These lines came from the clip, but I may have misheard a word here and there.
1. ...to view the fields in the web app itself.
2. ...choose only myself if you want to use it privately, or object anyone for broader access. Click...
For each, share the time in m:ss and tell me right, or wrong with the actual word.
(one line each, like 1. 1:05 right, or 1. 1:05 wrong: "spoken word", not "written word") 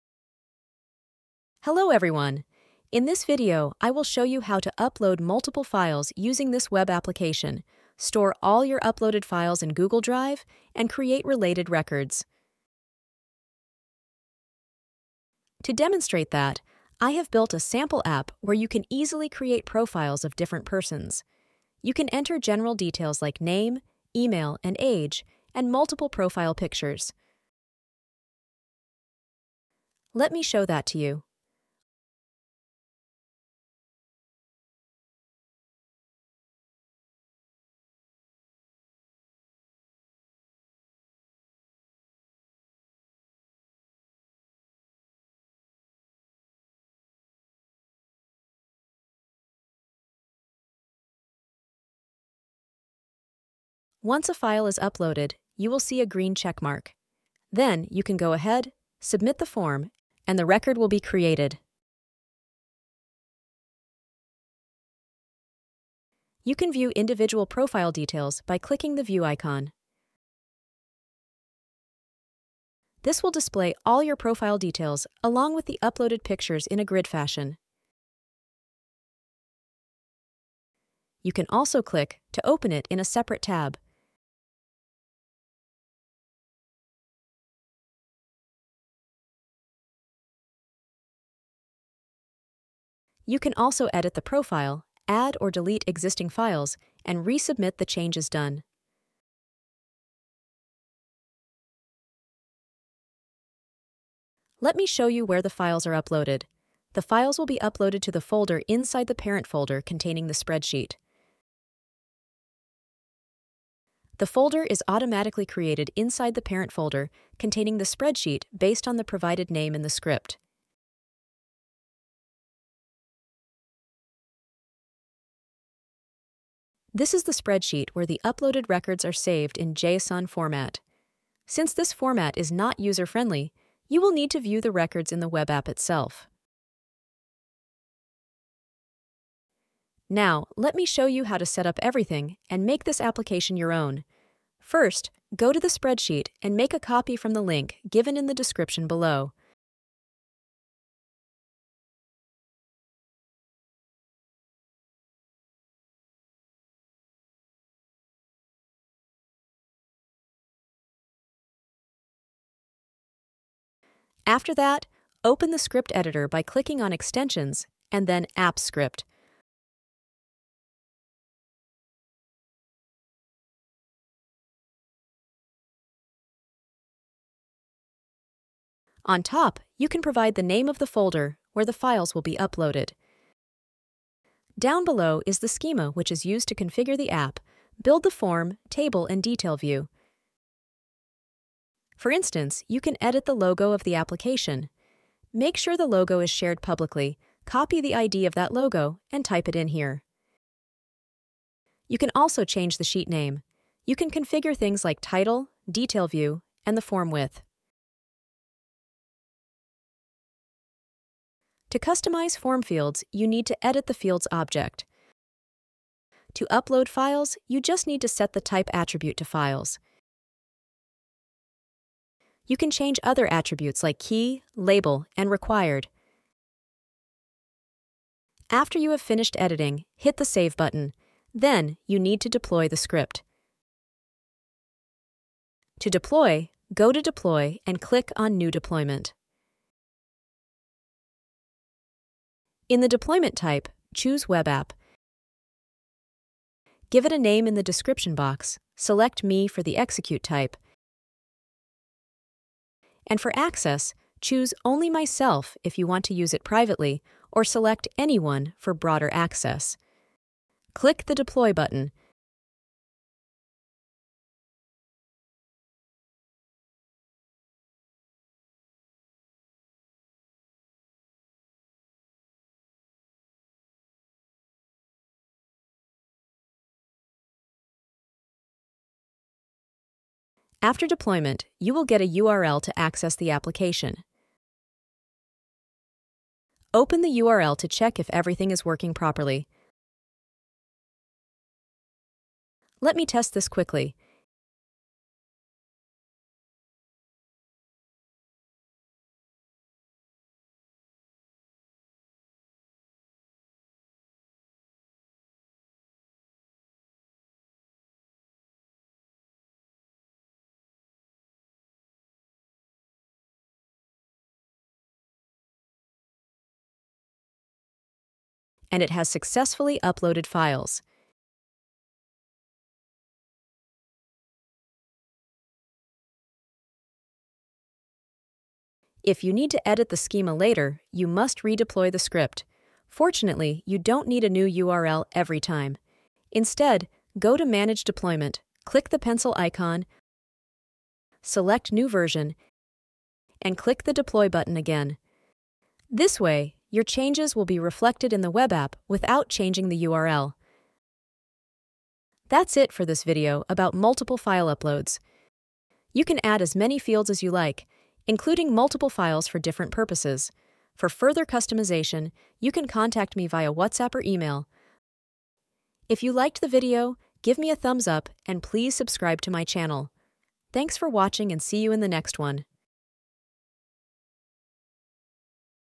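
1. 2:14 wrong: "records", not "fields"
2. 4:14 wrong: "select", not "object".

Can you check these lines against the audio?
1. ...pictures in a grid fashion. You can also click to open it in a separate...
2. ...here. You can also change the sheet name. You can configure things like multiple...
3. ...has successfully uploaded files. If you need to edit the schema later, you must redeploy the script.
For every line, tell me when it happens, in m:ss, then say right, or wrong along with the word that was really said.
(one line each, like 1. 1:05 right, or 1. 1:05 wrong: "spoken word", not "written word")
1. 1:16 right
2. 3:19 wrong: "title", not "multiple"
3. 5:18 right.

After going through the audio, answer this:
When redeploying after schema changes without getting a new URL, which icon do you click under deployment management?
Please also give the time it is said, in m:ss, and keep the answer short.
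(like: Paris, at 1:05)
pencil icon, at 5:38.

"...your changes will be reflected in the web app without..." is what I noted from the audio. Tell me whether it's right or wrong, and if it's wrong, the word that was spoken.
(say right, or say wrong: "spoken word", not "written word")
right.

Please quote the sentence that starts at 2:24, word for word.
First, go to the spreadsheet and make a copy from the link given in the description below.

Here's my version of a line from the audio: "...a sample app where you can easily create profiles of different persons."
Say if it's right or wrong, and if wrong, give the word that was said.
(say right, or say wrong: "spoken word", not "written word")
right.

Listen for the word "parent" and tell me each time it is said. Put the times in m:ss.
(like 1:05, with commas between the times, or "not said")
1:49, 1:56.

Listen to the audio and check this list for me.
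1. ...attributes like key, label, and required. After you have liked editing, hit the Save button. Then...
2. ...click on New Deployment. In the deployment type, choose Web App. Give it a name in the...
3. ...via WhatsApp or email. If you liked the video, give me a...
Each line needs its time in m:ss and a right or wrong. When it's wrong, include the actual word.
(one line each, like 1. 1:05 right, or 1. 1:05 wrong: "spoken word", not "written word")
1. 3:43 wrong: "finished", not "liked"
2. 3:57 right
3. 6:03 right.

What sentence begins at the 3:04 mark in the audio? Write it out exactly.
Down below is the schema which is used to configure the app, build the form, table, and detail view.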